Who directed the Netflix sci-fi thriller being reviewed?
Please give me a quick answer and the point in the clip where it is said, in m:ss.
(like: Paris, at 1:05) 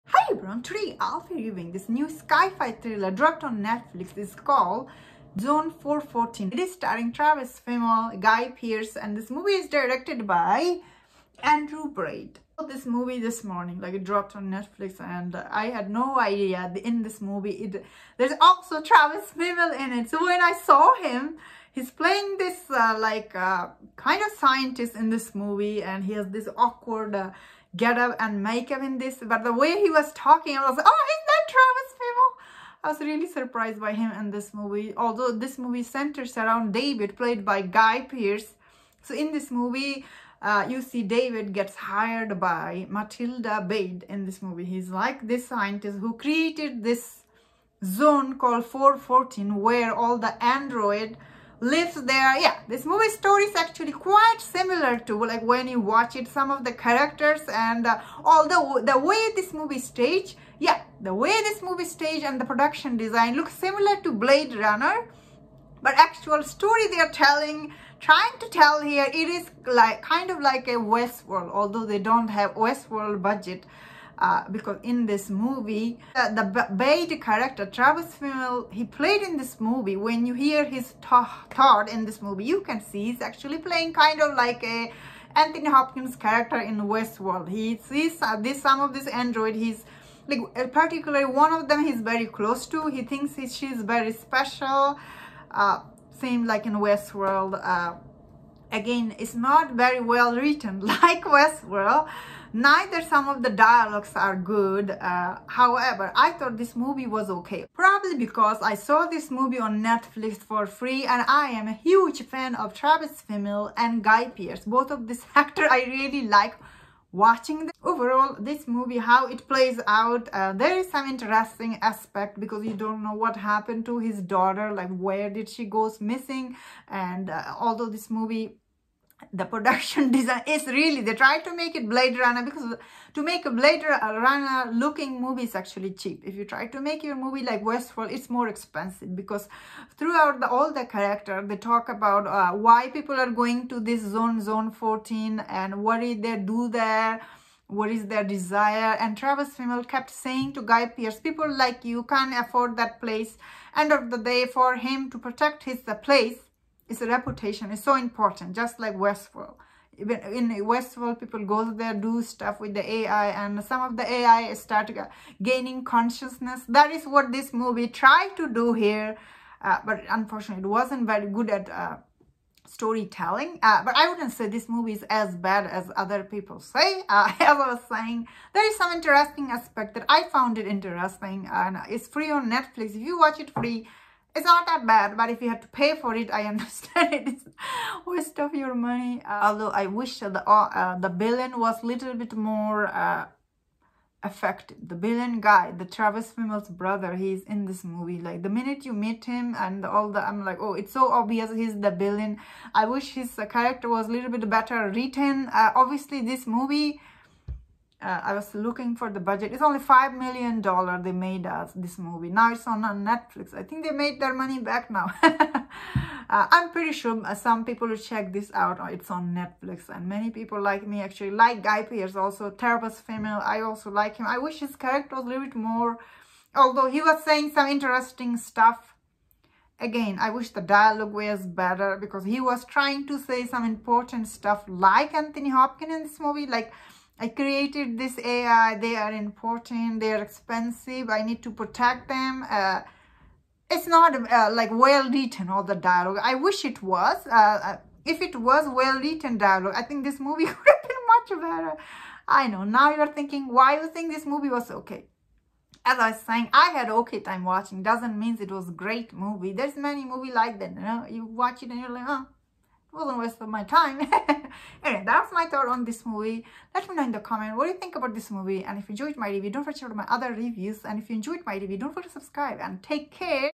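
Andrew Baird, at 0:11.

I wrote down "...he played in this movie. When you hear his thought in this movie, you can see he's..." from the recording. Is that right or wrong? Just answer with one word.
right.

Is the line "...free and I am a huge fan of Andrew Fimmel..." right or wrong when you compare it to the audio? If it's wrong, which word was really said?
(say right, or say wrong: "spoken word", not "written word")
wrong: "Travis", not "Andrew".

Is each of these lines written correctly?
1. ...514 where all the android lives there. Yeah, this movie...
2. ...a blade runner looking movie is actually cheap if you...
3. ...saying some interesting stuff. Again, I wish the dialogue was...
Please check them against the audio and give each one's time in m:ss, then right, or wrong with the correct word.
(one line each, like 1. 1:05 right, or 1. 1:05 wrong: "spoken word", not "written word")
1. 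0:48 wrong: "414", not "514"
2. 2:13 right
3. 3:47 right.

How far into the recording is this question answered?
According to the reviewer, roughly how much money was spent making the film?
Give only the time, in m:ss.
3:29.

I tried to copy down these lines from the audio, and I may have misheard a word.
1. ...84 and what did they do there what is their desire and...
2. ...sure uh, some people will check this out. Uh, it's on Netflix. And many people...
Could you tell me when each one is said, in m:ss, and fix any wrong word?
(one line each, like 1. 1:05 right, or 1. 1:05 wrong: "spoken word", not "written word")
1. 2:24 wrong: "14", not "84"
2. 3:36 right.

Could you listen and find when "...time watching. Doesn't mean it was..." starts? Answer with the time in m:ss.
4:17.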